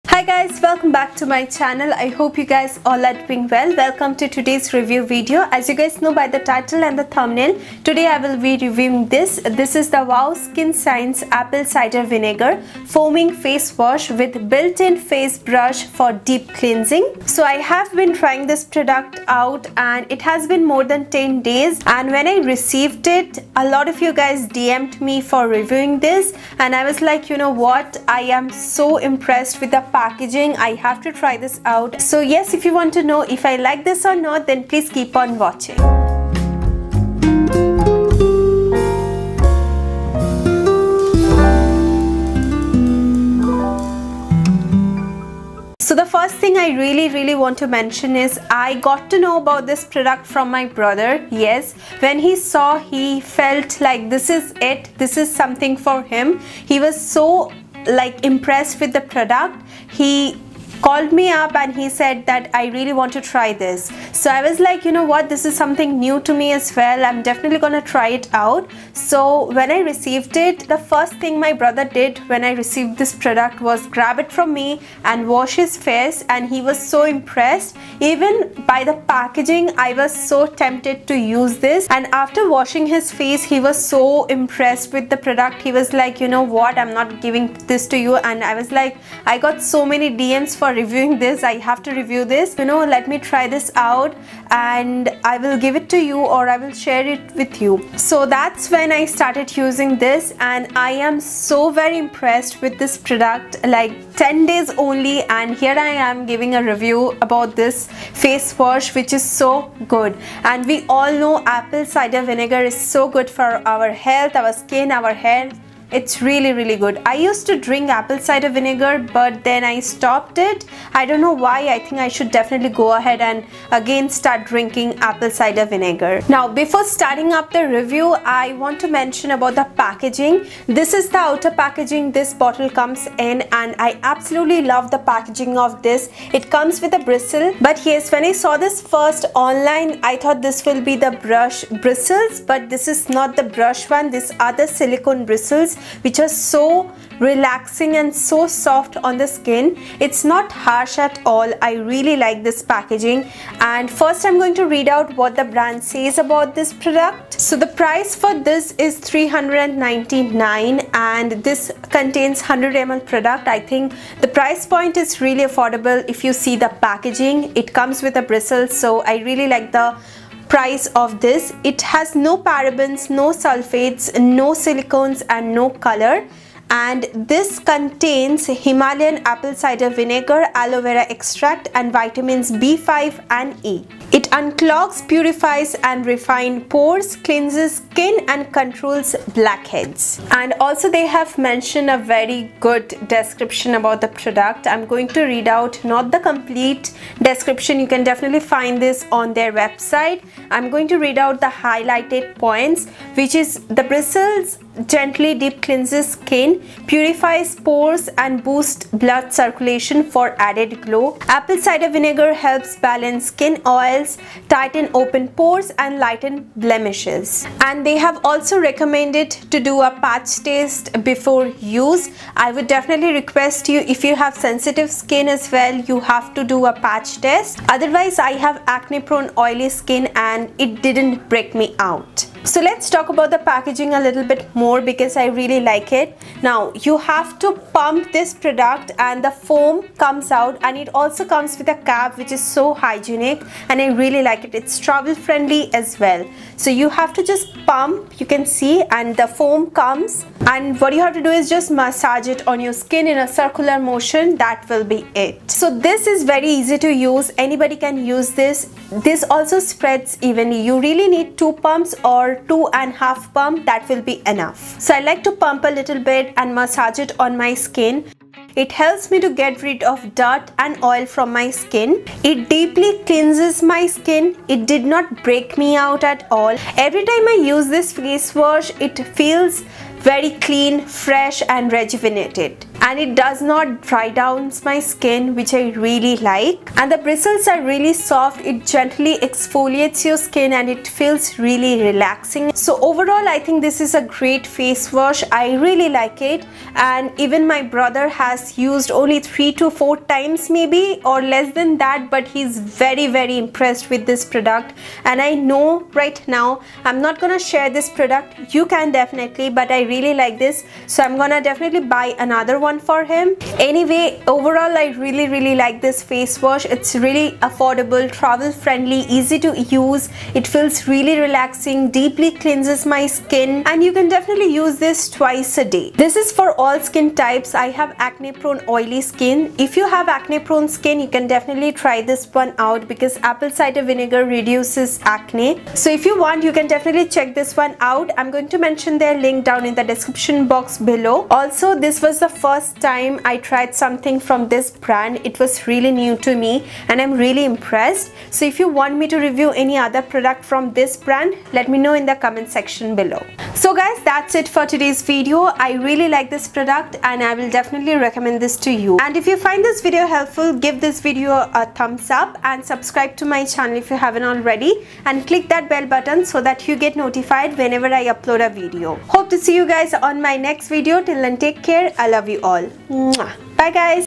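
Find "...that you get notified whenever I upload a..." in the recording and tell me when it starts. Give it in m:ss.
6:06.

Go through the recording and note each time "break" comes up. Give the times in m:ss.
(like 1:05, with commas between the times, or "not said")
3:51, 4:35.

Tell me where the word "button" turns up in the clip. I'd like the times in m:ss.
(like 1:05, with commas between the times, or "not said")
6:05.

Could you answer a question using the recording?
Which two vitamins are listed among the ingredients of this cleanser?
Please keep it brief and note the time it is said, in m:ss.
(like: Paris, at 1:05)
B5 and E, at 3:02.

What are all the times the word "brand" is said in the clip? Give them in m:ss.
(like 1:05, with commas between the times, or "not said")
2:35, 5:44, 5:51.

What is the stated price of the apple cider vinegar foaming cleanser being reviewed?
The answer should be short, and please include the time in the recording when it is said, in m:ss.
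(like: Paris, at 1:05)
399, at 2:38.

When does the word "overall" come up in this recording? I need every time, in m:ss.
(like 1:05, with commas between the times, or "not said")
4:52, 5:14.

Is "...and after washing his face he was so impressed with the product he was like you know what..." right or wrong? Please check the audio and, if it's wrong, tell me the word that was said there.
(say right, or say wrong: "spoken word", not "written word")
right.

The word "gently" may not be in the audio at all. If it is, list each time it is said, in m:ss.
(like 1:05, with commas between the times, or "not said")
3:24, 4:48.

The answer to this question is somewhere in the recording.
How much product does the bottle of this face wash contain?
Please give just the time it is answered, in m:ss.
2:42.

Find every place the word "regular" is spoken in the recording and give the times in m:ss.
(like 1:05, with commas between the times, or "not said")
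not said.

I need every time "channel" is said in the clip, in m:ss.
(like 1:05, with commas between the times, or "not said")
0:01, 6:03.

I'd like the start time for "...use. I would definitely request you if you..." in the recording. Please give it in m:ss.
3:41.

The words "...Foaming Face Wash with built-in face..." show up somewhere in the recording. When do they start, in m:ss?
0:12.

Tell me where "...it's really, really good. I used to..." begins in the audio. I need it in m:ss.
1:55.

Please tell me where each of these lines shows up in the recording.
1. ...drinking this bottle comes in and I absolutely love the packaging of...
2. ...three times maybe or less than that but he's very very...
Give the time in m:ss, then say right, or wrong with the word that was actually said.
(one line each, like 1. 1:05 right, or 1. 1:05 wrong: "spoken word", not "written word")
1. 2:11 wrong: "packaging", not "drinking"
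2. 4:59 wrong: "four", not "three".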